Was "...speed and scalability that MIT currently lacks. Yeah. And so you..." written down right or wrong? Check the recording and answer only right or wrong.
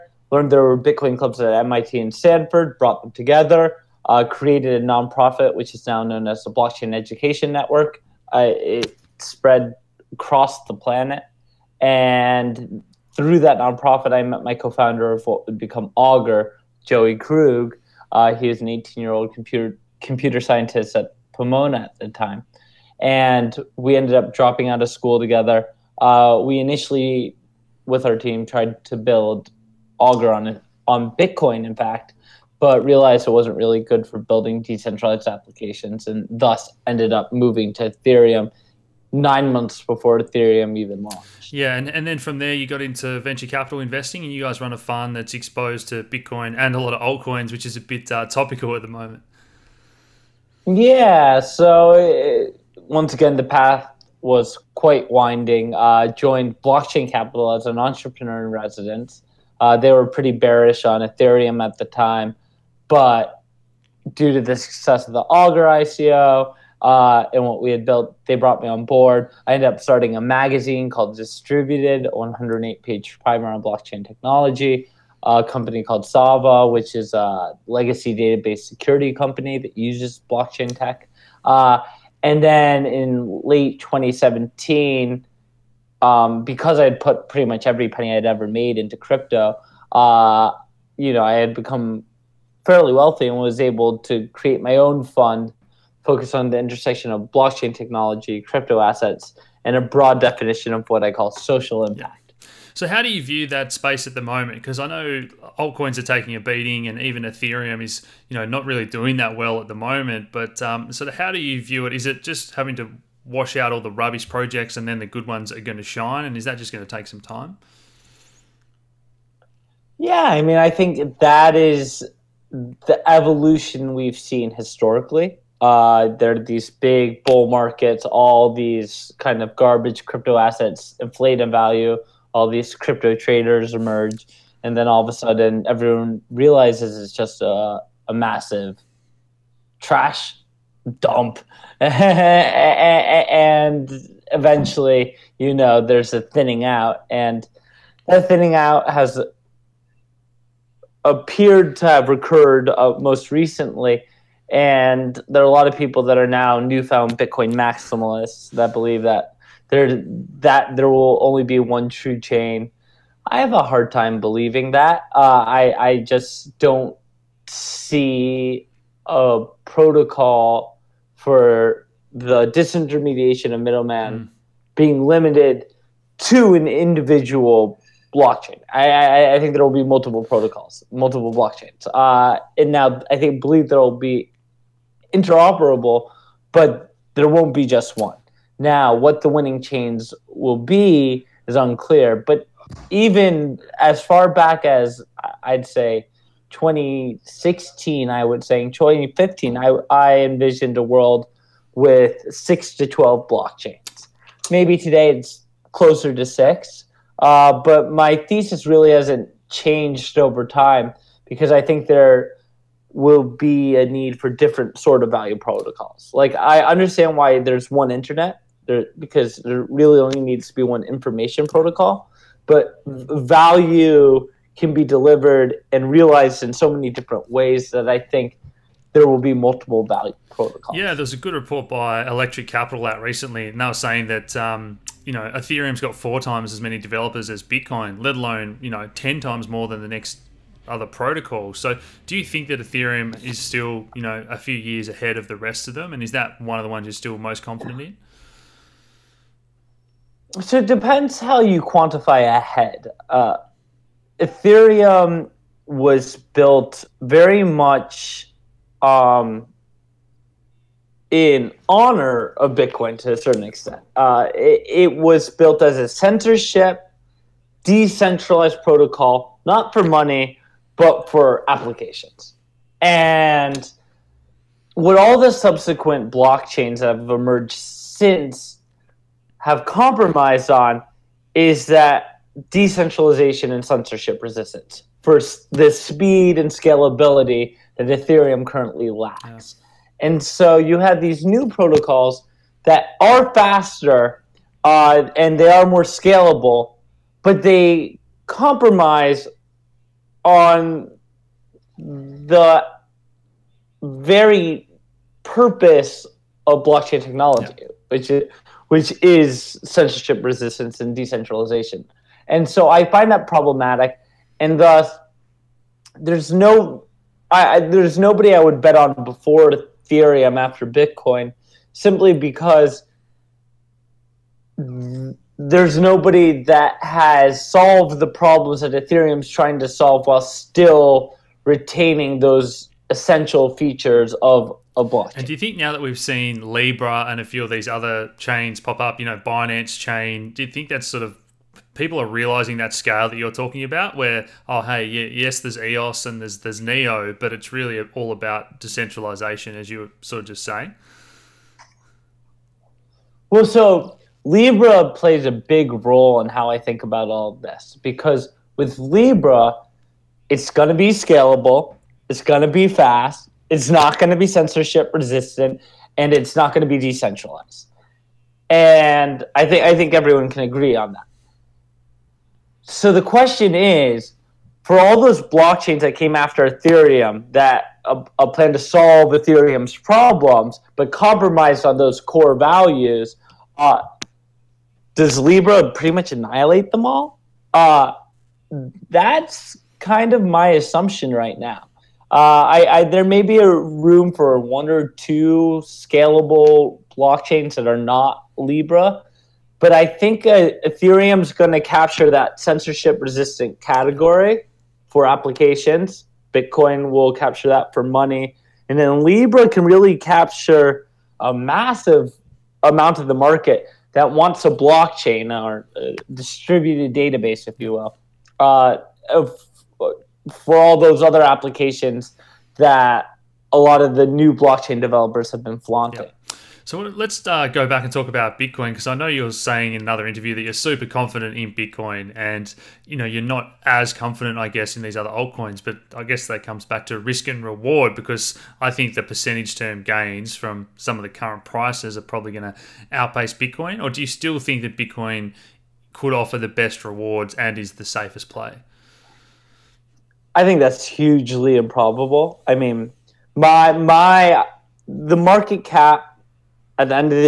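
wrong.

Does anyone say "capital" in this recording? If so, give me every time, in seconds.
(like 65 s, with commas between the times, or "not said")
43 s, 57 s, 232 s.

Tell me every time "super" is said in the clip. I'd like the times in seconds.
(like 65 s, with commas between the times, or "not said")
430 s.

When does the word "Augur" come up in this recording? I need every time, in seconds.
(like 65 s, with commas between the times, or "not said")
15 s, 29 s, 65 s.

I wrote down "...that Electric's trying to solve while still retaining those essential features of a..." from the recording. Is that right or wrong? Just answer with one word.
wrong.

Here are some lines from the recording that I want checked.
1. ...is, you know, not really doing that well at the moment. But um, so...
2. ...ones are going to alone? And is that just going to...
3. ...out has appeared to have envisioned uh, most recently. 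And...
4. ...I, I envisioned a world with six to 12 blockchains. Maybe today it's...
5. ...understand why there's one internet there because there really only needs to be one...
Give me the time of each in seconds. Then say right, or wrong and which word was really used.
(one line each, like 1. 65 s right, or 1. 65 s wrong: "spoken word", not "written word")
1. 107 s right
2. 115 s wrong: "shine", not "alone"
3. 148 s wrong: "recurred", not "envisioned"
4. 199 s right
5. 216 s right.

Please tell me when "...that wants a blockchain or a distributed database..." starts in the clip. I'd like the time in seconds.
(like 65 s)
413 s.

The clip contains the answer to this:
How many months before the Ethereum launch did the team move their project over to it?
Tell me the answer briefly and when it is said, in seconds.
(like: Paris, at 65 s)
9, at 39 s.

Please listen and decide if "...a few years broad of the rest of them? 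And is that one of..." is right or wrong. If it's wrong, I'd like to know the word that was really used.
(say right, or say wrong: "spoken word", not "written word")
wrong: "ahead", not "broad".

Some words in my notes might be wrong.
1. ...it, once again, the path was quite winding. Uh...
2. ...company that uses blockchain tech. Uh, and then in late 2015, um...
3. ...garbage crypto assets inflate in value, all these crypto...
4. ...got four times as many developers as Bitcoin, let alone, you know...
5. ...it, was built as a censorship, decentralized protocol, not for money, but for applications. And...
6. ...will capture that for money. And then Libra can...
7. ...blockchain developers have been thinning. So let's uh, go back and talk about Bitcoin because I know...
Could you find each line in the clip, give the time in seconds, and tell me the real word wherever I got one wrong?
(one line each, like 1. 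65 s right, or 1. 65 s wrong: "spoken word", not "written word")
1. 51 s right
2. 79 s wrong: "2017", not "2015"
3. 129 s right
4. 235 s right
5. 264 s right
6. 406 s right
7. 424 s wrong: "flaunting", not "thinning".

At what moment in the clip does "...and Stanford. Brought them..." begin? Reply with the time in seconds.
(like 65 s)
1 s.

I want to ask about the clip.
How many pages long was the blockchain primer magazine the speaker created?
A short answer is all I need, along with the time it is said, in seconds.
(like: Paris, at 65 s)
108, at 72 s.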